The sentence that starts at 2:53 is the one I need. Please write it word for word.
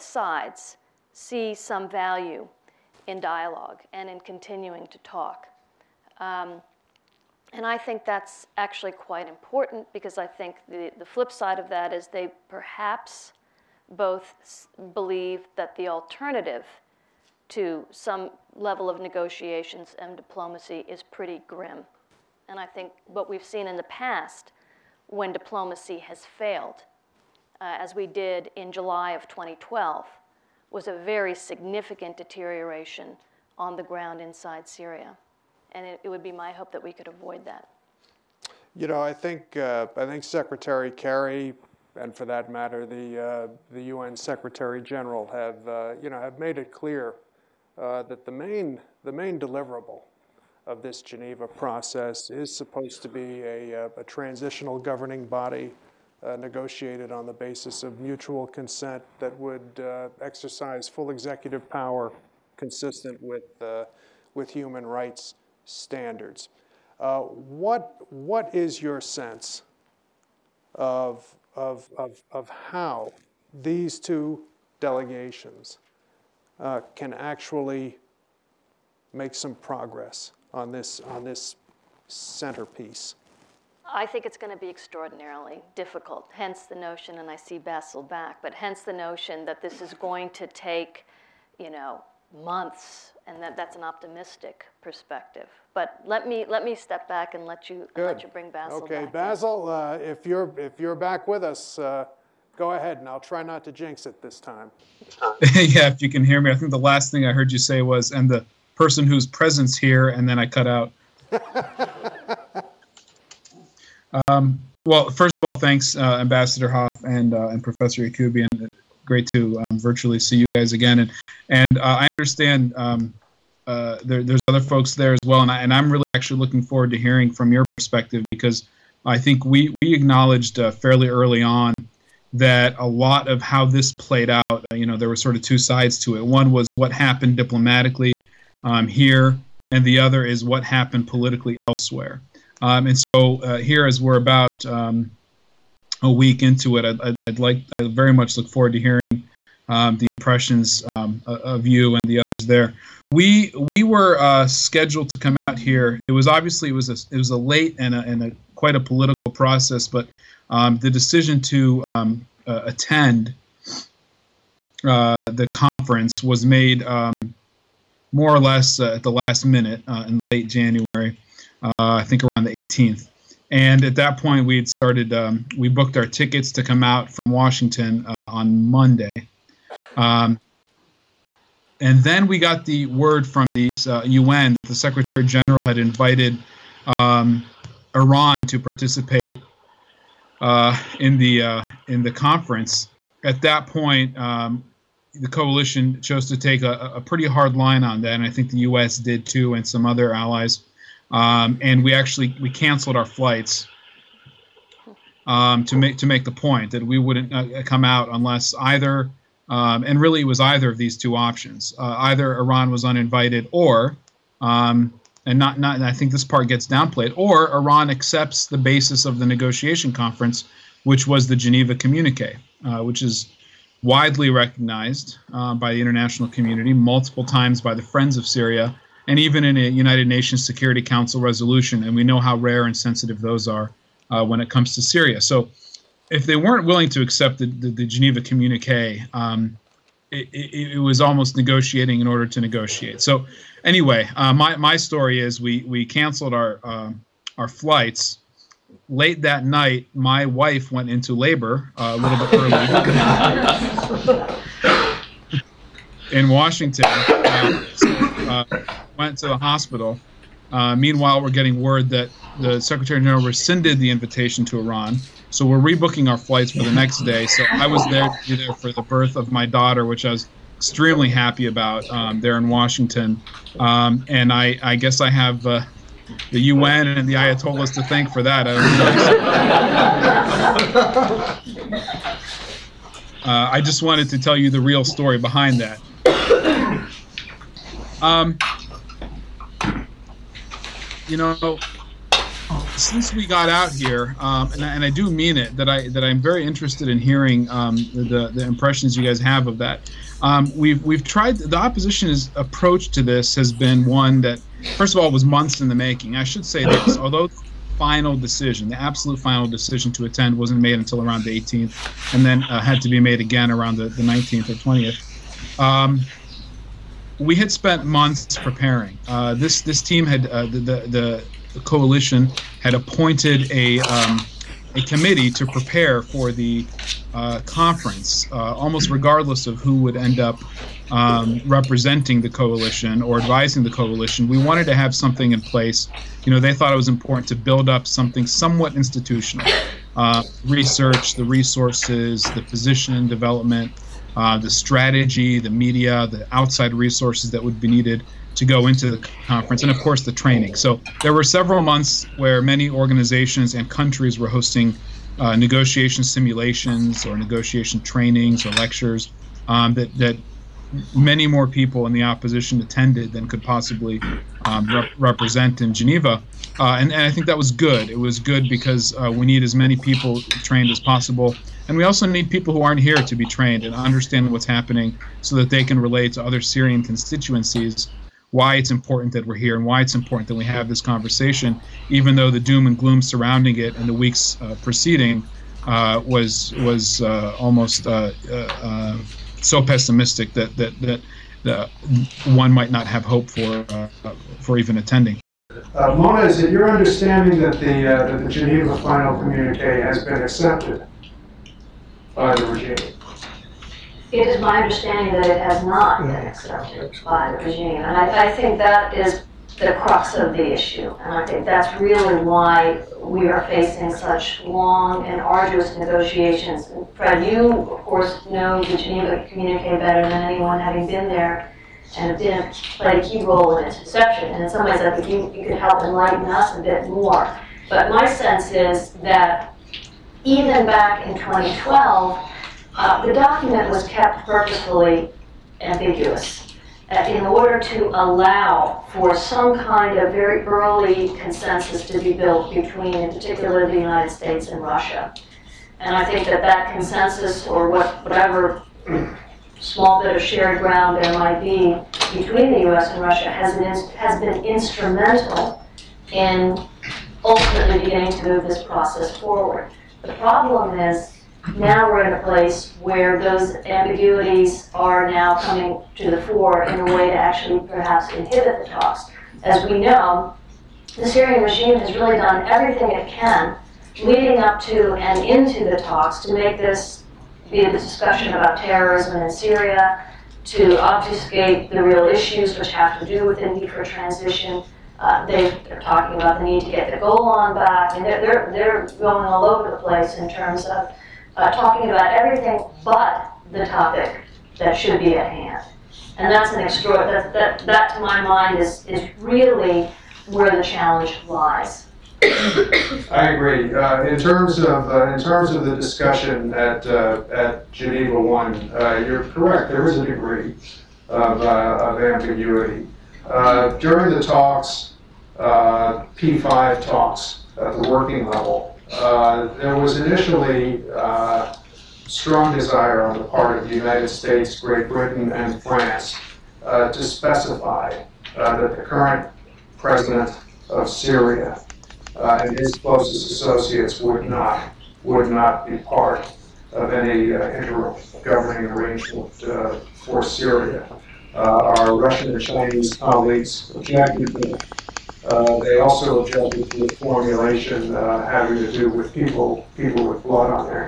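And at that point, we had started, um, we booked our tickets to come out from Washington uh, on Monday.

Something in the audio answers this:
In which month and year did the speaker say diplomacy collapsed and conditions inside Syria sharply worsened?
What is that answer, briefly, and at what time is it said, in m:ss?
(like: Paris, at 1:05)
July 2012, at 0:28.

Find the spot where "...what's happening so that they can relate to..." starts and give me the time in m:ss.
6:14.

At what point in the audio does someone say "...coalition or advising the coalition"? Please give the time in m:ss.
5:32.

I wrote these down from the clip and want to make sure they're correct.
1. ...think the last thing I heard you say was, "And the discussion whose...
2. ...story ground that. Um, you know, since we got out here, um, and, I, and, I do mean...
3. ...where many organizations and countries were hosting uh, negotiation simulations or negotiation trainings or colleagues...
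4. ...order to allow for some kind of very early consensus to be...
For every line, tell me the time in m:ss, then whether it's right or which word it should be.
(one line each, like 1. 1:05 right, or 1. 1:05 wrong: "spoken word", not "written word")
1. 1:46 wrong: "person", not "discussion"
2. 4:44 wrong: "behind", not "ground"
3. 5:52 wrong: "lectures", not "colleagues"
4. 7:17 right.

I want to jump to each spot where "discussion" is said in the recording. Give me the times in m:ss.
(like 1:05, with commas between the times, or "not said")
7:57, 8:25.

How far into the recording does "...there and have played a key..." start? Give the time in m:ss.
7:01.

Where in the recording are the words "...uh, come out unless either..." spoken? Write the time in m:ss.
3:27.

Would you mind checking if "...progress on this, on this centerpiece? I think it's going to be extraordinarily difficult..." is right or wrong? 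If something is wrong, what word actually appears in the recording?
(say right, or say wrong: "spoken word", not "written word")
right.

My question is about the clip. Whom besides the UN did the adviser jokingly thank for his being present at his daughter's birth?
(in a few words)
the Ayatollahs.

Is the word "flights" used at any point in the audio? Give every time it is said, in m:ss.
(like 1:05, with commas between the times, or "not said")
3:23, 4:07, 4:26.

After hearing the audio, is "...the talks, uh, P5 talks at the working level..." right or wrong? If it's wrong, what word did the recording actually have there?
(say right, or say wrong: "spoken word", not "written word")
right.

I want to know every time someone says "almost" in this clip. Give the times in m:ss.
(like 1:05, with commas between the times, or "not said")
4:01, 5:28, 6:27.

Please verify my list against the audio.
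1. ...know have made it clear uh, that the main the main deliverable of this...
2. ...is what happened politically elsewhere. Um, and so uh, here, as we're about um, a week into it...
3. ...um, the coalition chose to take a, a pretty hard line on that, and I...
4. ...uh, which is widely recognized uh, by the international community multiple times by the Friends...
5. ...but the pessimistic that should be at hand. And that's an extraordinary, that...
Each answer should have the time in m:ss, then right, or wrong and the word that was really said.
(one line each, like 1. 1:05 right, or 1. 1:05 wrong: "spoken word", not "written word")
1. 0:46 right
2. 2:20 right
3. 3:14 right
4. 3:42 right
5. 8:12 wrong: "topic", not "pessimistic".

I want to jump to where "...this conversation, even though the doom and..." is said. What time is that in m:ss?
6:20.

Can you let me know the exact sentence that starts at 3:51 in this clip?
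And we know how rare and sensitive those are uh, when it comes to Syria.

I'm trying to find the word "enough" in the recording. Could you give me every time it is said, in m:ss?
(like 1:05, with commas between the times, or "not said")
not said.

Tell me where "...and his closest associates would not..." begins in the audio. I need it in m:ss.
8:52.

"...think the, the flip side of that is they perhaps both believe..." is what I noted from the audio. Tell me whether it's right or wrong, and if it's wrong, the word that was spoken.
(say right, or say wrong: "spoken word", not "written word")
right.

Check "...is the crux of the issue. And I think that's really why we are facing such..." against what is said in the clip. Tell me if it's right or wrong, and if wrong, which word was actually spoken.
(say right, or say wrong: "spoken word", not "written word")
right.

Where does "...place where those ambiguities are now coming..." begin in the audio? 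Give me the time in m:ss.
7:42.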